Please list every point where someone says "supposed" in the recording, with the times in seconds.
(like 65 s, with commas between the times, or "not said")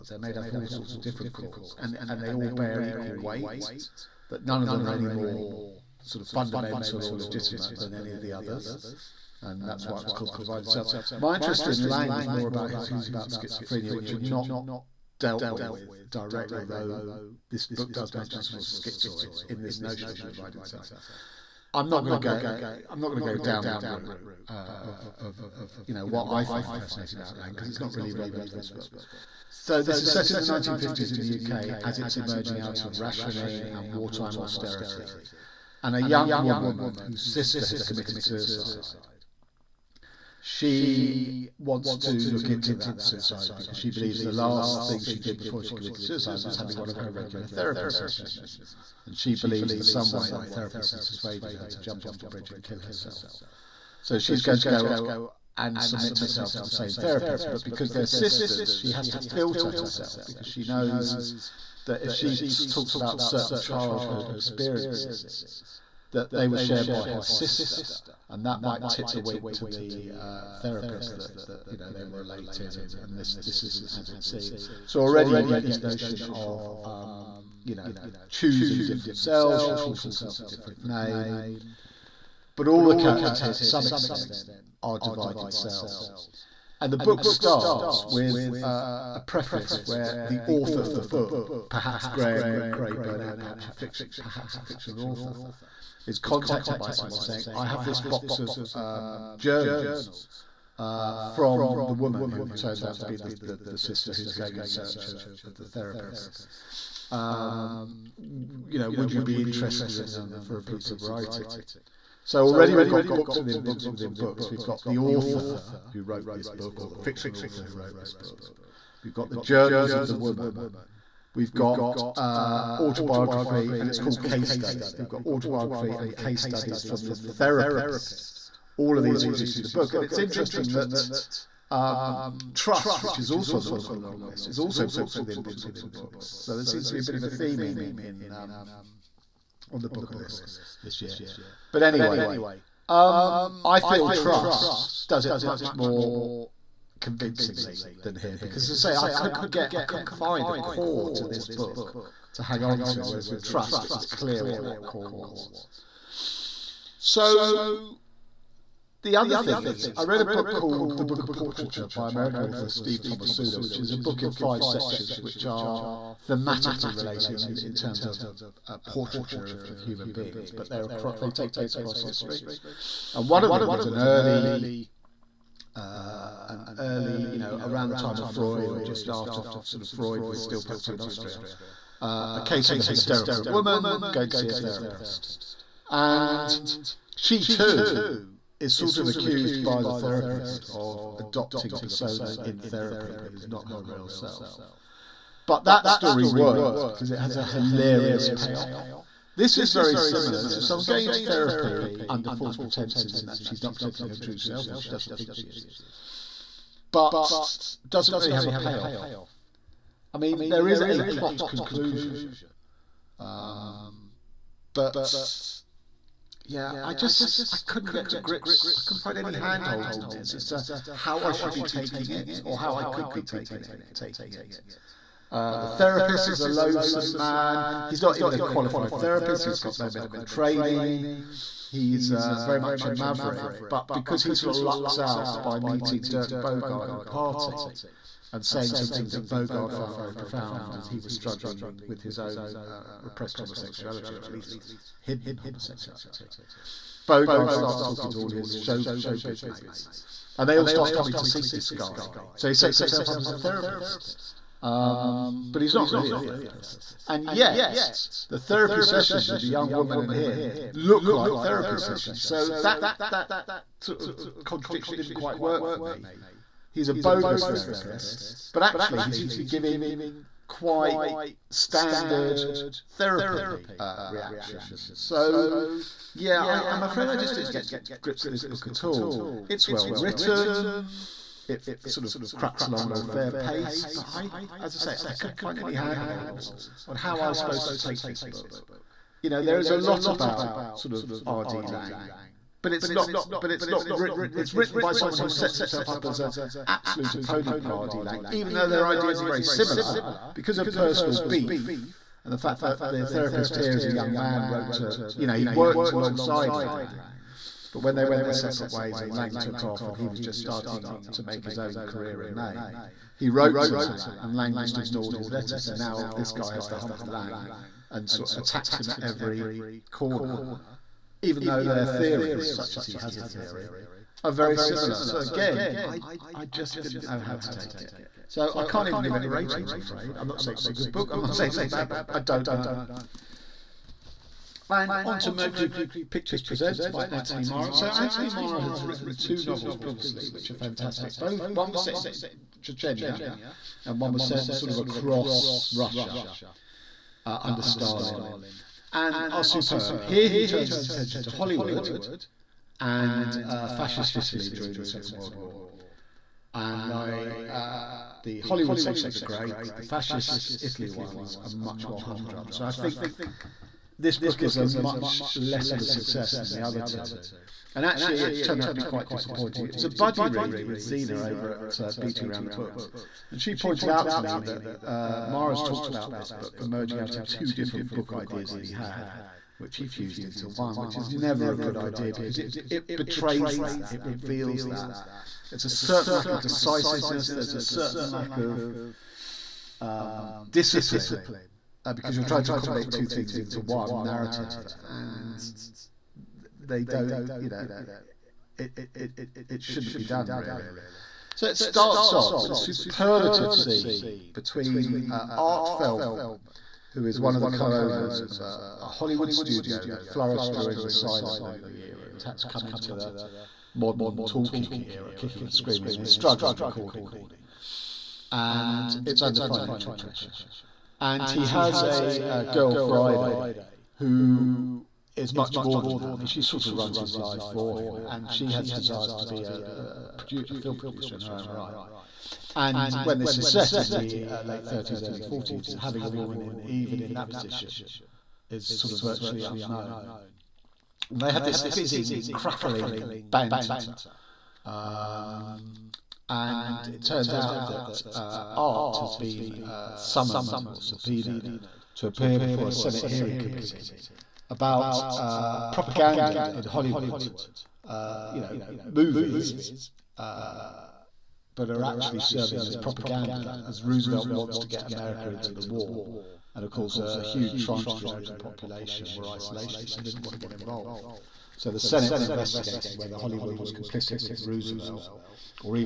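287 s.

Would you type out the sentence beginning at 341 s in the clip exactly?
Both one was set in Chechnya, and one was set sort of across Russia uh, under Stalin, and are oh, superb.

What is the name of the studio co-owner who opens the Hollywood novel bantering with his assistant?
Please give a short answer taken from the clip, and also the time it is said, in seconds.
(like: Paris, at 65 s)
Art Feldman, at 405 s.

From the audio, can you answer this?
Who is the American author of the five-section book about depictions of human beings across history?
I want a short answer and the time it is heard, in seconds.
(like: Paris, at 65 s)
Steve Tomasula, at 162 s.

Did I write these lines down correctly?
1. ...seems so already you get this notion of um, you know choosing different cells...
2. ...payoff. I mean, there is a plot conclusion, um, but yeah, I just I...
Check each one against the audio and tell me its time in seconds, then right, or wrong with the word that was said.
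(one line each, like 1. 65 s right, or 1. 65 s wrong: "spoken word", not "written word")
1. 74 s right
2. 208 s right.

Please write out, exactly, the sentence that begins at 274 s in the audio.
So yeah, I, I'm afraid I just didn't get to grips with this book at all.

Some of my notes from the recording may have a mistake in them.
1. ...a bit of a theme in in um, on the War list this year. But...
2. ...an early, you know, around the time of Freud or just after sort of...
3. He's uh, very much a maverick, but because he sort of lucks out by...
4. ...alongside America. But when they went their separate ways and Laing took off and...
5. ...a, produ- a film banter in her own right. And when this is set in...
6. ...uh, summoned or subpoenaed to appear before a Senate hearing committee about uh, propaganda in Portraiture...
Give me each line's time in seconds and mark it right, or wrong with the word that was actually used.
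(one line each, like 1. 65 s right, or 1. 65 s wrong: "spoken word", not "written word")
1. 136 s wrong: "Booker", not "War"
2. 176 s right
3. 231 s right
4. 305 s wrong: "Laing", not "America"
5. 430 s wrong: "producer", not "banter"
6. 449 s wrong: "Hollywood", not "Portraiture".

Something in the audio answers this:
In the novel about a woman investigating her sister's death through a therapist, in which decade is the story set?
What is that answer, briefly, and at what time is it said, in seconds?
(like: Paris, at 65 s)
1950s, at 30 s.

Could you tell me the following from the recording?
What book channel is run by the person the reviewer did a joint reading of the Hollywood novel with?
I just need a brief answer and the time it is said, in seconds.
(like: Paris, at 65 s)
Beating Around the Books, at 371 s.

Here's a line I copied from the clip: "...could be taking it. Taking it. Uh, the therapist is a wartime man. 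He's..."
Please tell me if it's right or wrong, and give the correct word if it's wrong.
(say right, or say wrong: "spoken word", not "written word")
wrong: "loathsome", not "wartime".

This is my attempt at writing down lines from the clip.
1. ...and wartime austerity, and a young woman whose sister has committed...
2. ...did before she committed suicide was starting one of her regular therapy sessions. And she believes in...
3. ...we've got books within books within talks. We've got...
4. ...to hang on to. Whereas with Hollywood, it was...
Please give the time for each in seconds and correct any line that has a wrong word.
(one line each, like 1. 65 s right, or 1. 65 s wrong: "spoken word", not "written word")
1. 33 s right
2. 45 s wrong: "having", not "starting"
3. 112 s wrong: "books", not "talks"
4. 152 s wrong: "Trust", not "Hollywood".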